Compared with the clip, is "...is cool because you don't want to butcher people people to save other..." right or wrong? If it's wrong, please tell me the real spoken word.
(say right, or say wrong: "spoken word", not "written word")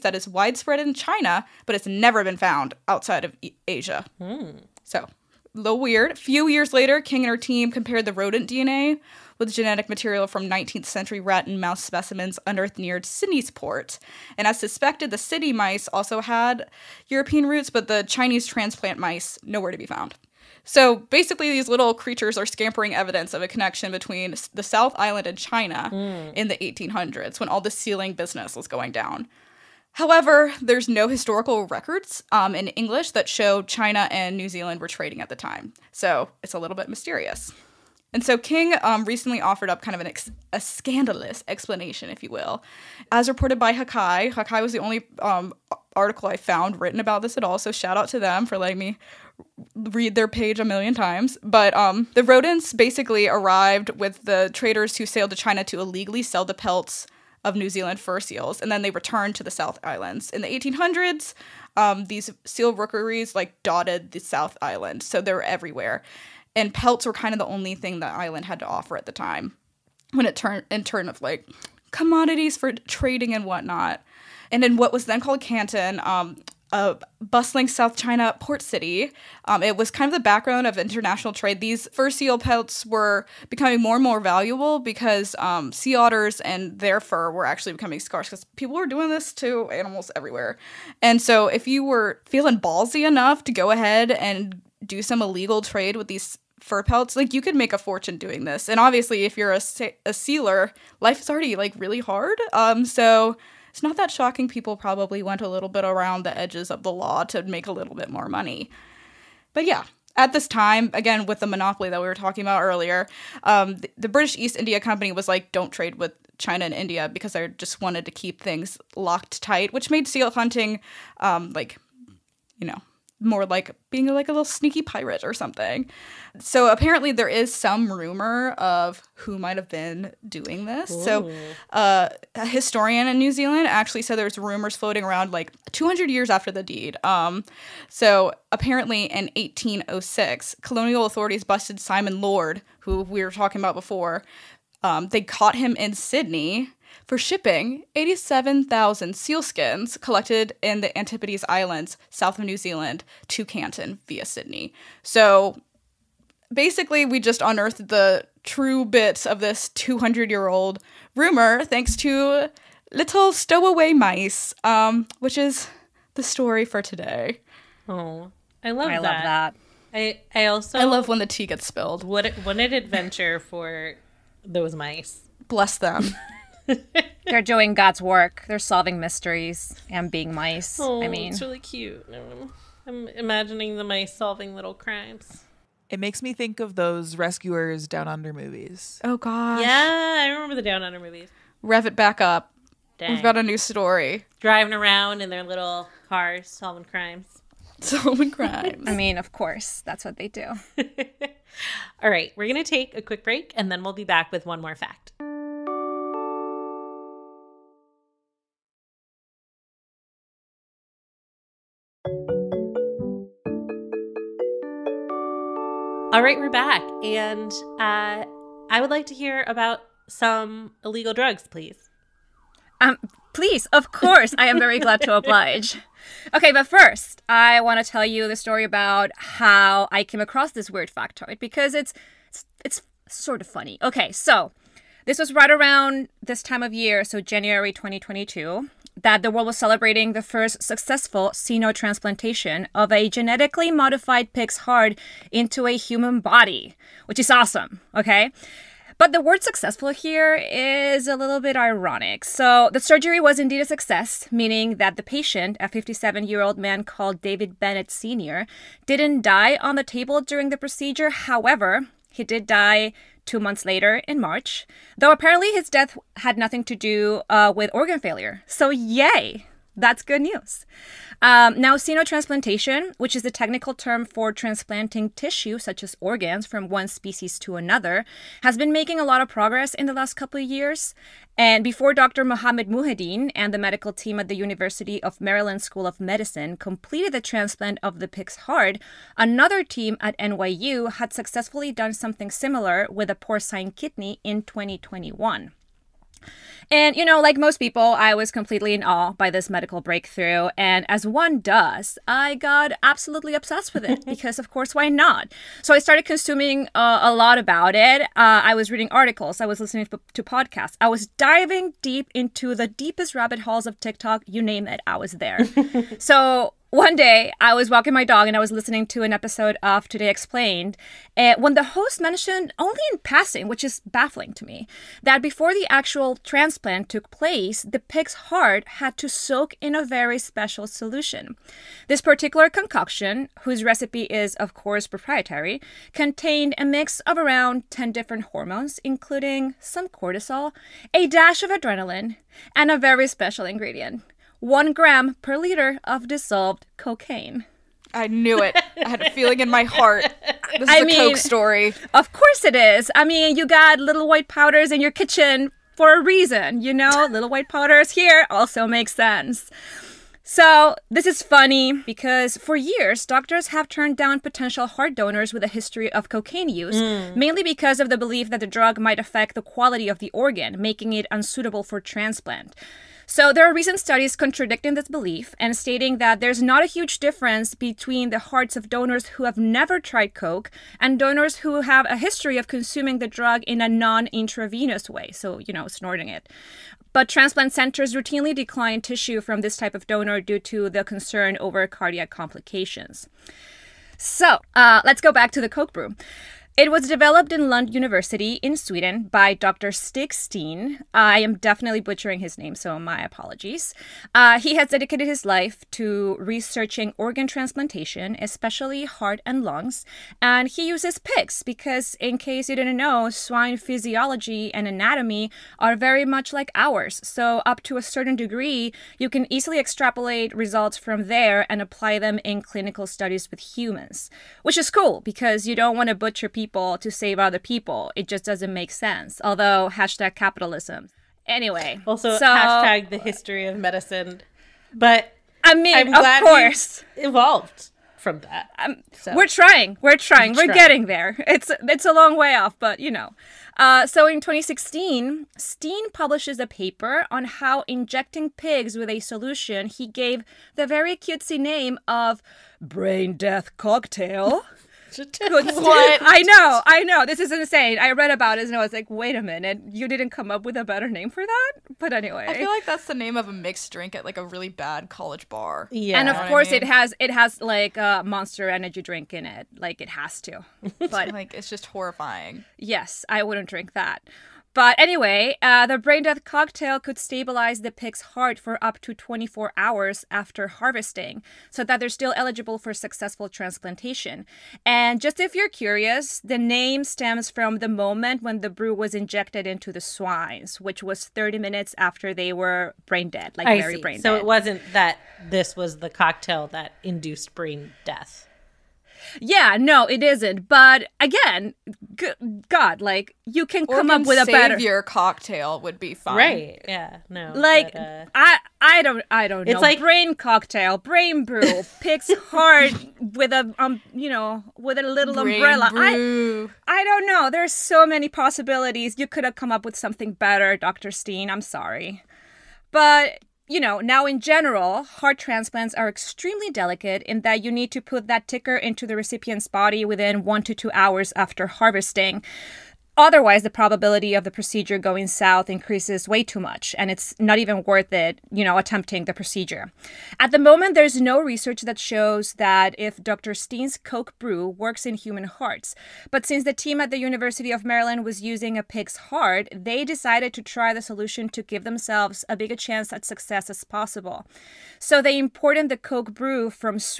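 right.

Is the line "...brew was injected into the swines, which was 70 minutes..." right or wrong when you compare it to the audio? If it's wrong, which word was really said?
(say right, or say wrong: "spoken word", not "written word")
wrong: "30", not "70".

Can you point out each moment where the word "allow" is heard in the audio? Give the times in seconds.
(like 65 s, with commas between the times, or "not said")
not said.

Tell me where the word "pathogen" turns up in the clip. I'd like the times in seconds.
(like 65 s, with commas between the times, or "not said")
not said.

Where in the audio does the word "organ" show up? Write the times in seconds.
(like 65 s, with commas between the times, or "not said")
267 s, 275 s, 370 s, 406 s.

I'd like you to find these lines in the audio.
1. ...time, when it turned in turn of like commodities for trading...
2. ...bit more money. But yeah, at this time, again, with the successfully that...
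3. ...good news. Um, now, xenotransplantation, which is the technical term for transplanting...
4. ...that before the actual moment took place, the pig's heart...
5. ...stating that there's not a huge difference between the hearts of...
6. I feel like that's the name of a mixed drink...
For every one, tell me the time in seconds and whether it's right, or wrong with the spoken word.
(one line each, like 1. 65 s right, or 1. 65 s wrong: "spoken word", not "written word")
1. 69 s right
2. 107 s wrong: "monopoly", not "successfully"
3. 270 s right
4. 325 s wrong: "transplant", not "moment"
5. 375 s right
6. 462 s right.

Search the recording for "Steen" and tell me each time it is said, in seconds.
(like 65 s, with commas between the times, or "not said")
400 s, 445 s, 520 s, 543 s.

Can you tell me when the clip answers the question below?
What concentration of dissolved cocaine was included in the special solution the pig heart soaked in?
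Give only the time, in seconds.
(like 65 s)
344 s.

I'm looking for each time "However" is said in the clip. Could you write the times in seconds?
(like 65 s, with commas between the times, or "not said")
29 s, 261 s.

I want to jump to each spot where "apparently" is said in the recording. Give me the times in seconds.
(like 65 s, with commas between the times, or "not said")
126 s, 138 s, 265 s.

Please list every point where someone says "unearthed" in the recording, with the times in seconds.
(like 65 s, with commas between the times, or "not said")
12 s, 157 s.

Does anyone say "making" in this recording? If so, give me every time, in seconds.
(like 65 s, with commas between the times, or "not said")
278 s, 370 s.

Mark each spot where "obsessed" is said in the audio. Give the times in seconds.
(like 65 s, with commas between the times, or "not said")
303 s.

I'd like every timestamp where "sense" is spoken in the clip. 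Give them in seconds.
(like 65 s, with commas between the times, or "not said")
358 s, 428 s.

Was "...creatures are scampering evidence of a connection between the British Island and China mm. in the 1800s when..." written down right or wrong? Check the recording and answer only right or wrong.
wrong.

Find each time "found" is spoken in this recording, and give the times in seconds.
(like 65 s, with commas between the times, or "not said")
2 s, 19 s, 46 s.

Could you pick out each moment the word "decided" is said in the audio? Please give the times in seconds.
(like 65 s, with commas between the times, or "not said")
549 s.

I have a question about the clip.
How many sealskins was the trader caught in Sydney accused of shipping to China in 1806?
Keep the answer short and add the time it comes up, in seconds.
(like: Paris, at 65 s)
87,000, at 147 s.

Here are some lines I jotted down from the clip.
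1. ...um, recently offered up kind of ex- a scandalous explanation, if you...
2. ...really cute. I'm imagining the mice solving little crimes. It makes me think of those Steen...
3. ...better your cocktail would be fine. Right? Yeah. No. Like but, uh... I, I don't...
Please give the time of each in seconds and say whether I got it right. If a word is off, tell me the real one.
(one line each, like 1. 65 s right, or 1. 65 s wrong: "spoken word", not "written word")
1. 38 s right
2. 181 s wrong: "Rescuers", not "Steen"
3. 504 s right.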